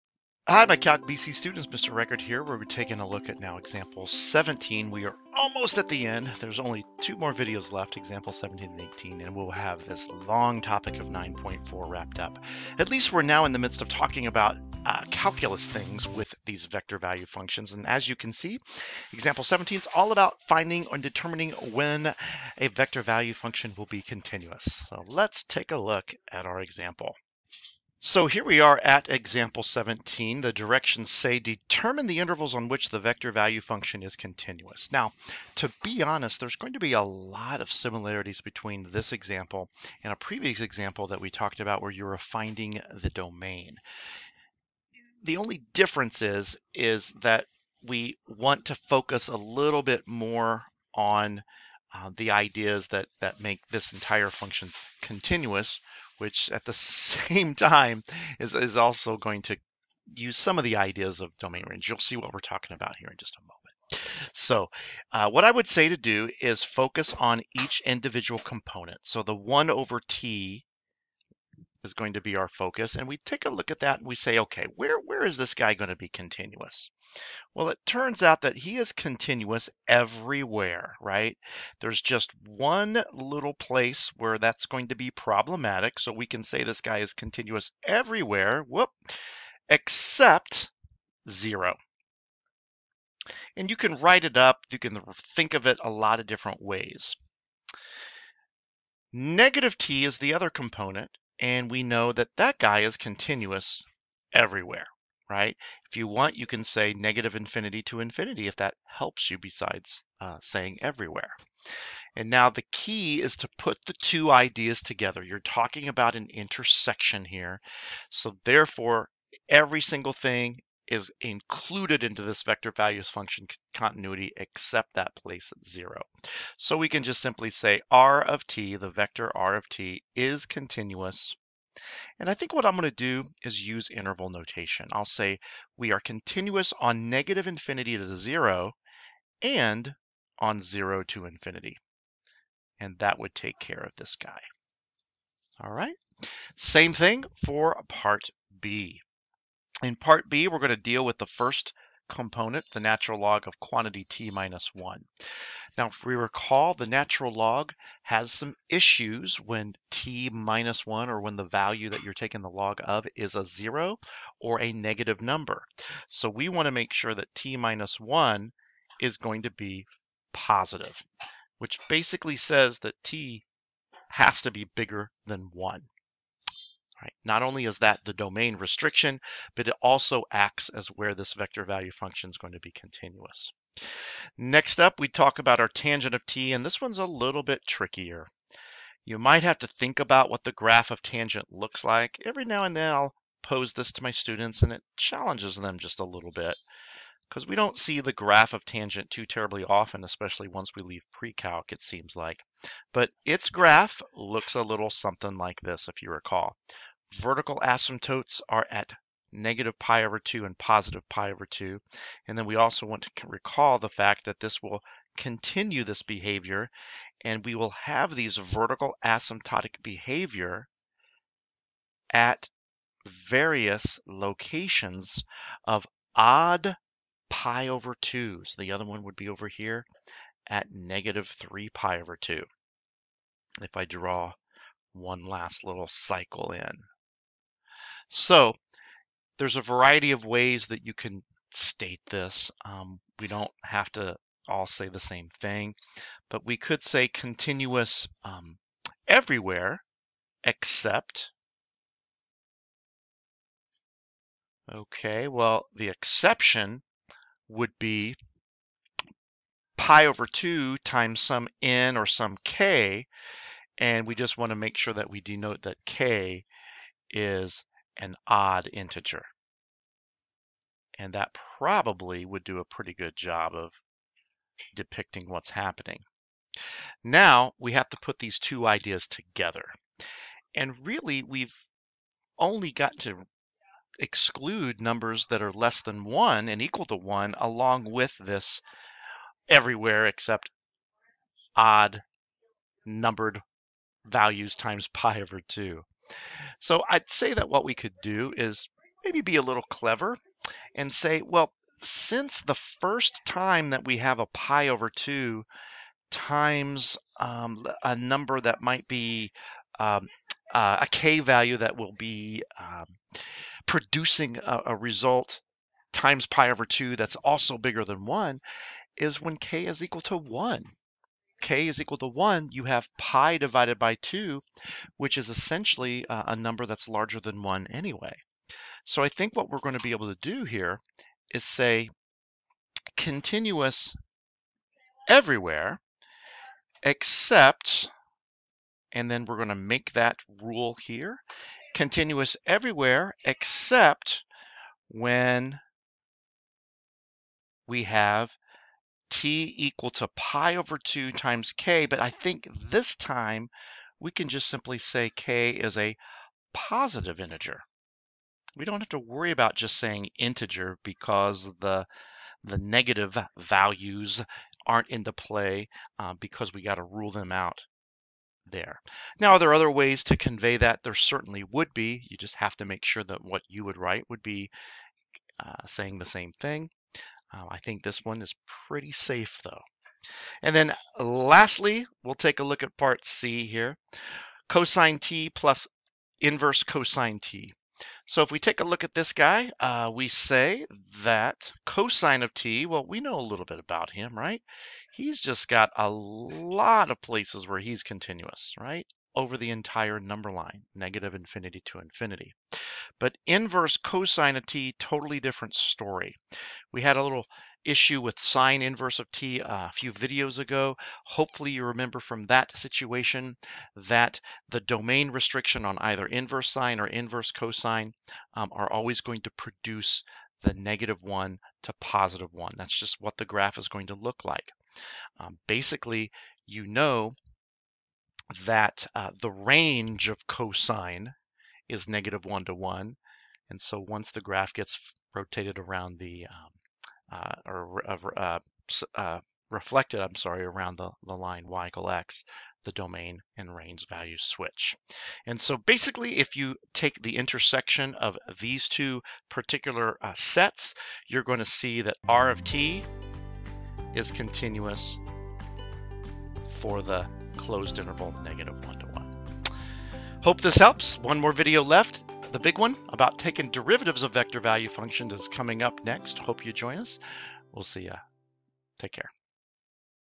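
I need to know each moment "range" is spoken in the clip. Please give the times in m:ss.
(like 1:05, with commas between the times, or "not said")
1:01, 7:09, 7:23.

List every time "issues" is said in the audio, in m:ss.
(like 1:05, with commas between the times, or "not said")
2:38, 6:47.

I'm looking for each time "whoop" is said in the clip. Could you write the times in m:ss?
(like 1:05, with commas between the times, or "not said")
1:28.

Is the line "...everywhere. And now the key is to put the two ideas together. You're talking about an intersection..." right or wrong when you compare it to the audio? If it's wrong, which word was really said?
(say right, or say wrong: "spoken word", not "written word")
right.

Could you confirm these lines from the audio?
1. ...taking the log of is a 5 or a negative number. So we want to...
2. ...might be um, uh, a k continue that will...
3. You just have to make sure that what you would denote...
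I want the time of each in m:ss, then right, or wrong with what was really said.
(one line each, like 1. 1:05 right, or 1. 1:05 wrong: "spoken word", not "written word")
1. 2:42 wrong: "0", not "5"
2. 5:08 wrong: "value", not "continue"
3. 6:12 wrong: "write", not "denote".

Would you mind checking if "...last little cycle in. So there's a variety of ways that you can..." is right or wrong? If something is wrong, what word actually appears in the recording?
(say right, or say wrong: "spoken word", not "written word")
right.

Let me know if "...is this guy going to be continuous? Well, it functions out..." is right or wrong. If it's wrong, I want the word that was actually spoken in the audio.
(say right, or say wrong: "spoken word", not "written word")
wrong: "turns", not "functions".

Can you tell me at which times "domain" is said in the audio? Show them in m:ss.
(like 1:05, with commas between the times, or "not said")
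0:43, 1:01, 2:58, 6:54, 7:22.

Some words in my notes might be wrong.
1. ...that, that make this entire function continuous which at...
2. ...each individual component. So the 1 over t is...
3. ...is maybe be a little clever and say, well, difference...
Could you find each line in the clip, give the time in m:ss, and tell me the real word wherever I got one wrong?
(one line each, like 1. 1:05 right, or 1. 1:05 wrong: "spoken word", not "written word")
1. 0:52 right
2. 1:07 right
3. 4:58 wrong: "since", not "difference".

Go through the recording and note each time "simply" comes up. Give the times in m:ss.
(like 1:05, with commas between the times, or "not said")
2:07, 5:54.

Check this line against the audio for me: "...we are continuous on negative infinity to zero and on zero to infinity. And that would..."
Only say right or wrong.
right.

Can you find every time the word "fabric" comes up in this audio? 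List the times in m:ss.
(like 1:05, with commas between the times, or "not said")
not said.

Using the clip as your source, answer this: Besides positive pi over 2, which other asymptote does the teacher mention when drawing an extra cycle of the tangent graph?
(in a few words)
negative 3 pi over 2.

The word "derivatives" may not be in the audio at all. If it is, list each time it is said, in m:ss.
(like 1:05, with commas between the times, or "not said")
7:43.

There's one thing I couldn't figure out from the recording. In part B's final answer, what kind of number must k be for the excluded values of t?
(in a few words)
positive integer.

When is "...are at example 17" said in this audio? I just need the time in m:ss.
0:28.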